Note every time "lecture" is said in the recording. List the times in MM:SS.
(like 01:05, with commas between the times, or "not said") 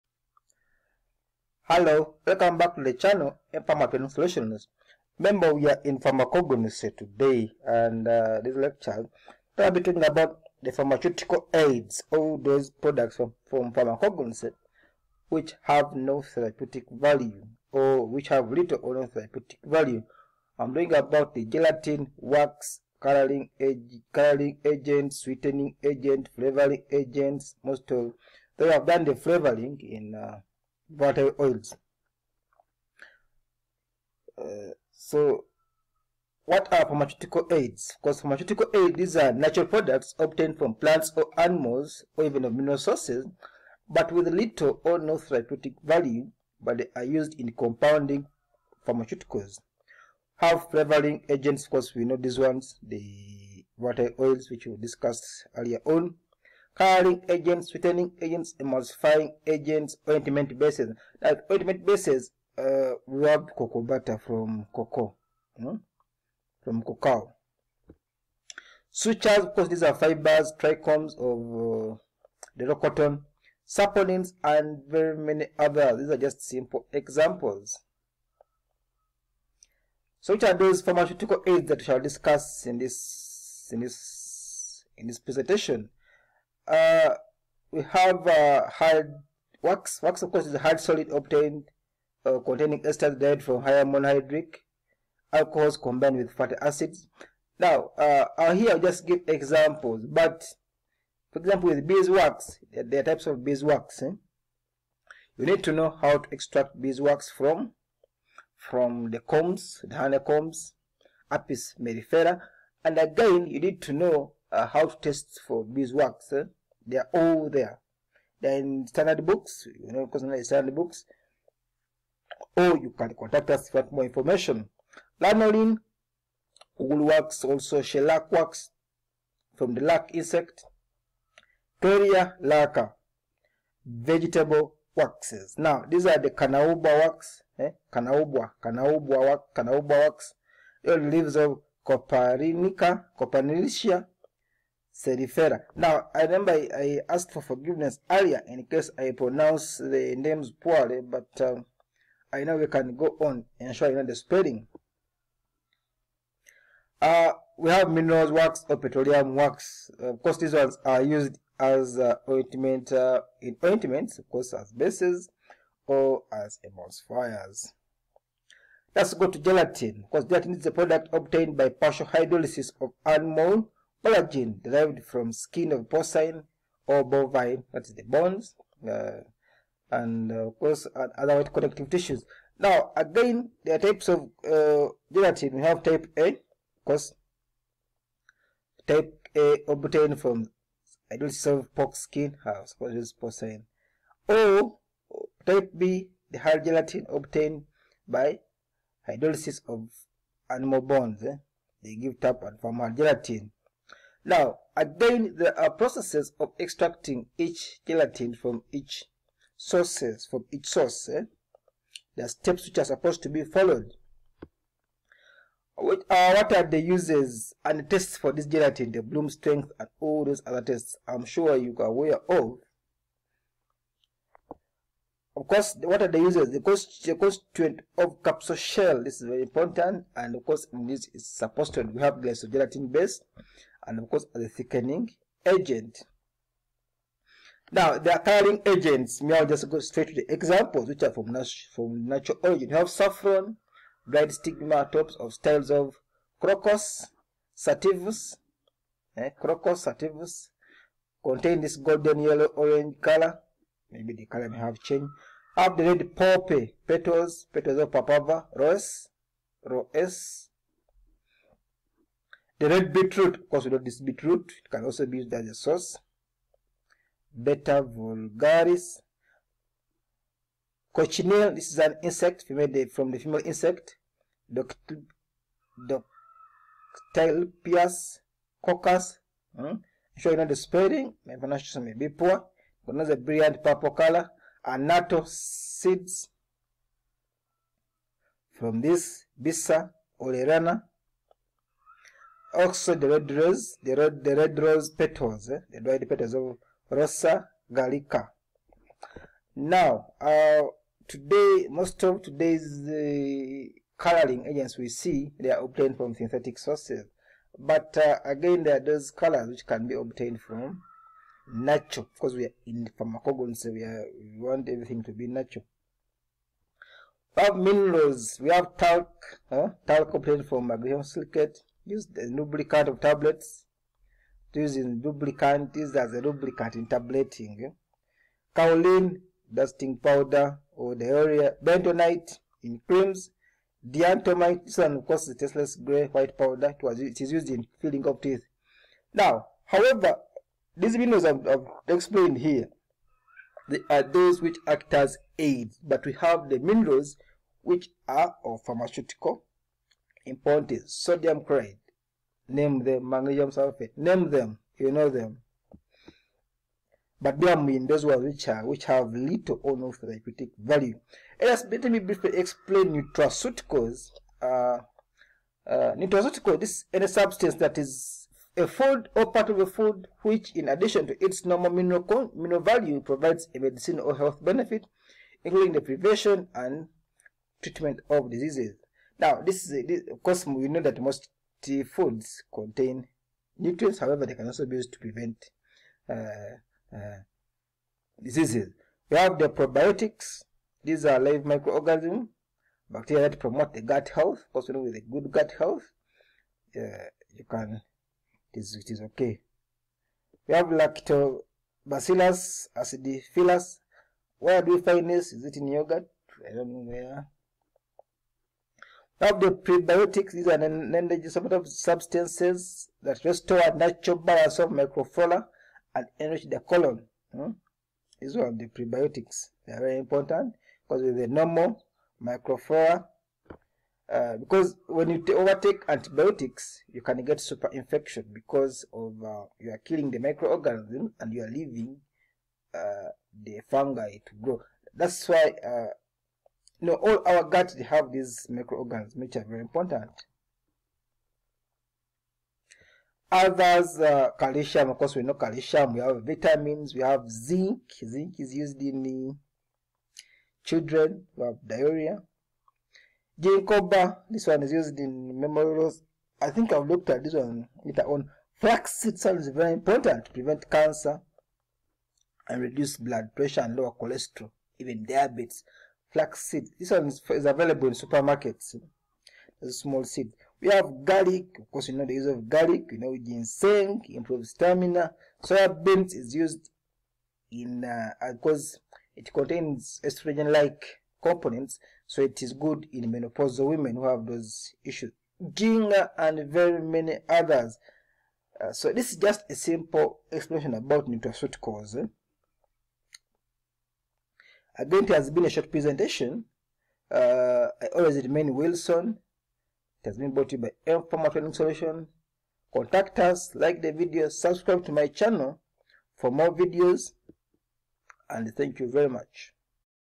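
00:08.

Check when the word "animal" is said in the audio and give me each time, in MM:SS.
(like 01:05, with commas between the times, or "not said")
00:41, 02:53, 03:20.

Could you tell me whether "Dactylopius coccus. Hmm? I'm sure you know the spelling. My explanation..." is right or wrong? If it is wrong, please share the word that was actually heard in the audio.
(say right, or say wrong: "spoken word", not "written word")
wrong: "pronunciation", not "explanation".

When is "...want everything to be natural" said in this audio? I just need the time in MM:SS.
05:14.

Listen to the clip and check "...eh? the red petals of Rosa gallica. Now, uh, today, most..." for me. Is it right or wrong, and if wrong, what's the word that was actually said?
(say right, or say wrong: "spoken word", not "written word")
right.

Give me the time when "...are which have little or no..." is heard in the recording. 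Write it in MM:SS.
05:58.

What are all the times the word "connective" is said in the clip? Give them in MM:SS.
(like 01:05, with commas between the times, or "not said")
03:01.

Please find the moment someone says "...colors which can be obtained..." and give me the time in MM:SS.
05:09.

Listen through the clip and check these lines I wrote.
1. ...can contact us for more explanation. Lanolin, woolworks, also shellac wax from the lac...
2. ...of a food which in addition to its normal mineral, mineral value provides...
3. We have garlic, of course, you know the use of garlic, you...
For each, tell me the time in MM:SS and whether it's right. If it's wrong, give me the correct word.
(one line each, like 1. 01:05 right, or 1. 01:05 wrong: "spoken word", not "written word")
1. 02:02 wrong: "information", not "explanation"
2. 06:09 right
3. 07:50 right.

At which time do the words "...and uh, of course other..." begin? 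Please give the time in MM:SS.
02:59.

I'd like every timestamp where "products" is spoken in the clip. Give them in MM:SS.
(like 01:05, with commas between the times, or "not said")
00:12, 00:39, 02:50.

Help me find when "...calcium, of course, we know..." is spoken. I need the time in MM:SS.
07:24.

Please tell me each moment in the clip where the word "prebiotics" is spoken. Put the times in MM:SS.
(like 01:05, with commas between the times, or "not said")
06:49, 06:58.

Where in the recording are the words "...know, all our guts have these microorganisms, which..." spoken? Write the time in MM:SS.
07:16.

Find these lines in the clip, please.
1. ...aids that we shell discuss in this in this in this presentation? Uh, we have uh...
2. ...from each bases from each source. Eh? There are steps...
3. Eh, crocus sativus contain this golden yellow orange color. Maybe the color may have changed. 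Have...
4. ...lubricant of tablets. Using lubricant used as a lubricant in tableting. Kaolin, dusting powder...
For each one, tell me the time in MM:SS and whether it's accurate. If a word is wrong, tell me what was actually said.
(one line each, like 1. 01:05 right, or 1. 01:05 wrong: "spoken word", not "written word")
1. 01:21 wrong: "shall", not "shell"
2. 03:28 wrong: "sources", not "bases"
3. 04:09 right
4. 05:22 right.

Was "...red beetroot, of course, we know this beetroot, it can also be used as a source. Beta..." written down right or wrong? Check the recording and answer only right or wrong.
wrong.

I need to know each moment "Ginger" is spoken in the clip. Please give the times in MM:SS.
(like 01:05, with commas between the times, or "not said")
08:05.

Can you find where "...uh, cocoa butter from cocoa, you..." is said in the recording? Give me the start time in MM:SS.
01:02.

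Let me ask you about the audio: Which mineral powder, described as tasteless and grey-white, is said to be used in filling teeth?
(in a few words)
Diatomite.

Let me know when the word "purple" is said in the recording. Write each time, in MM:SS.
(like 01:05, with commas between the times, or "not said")
04:43.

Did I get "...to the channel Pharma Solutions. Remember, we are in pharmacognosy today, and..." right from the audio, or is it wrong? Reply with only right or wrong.
right.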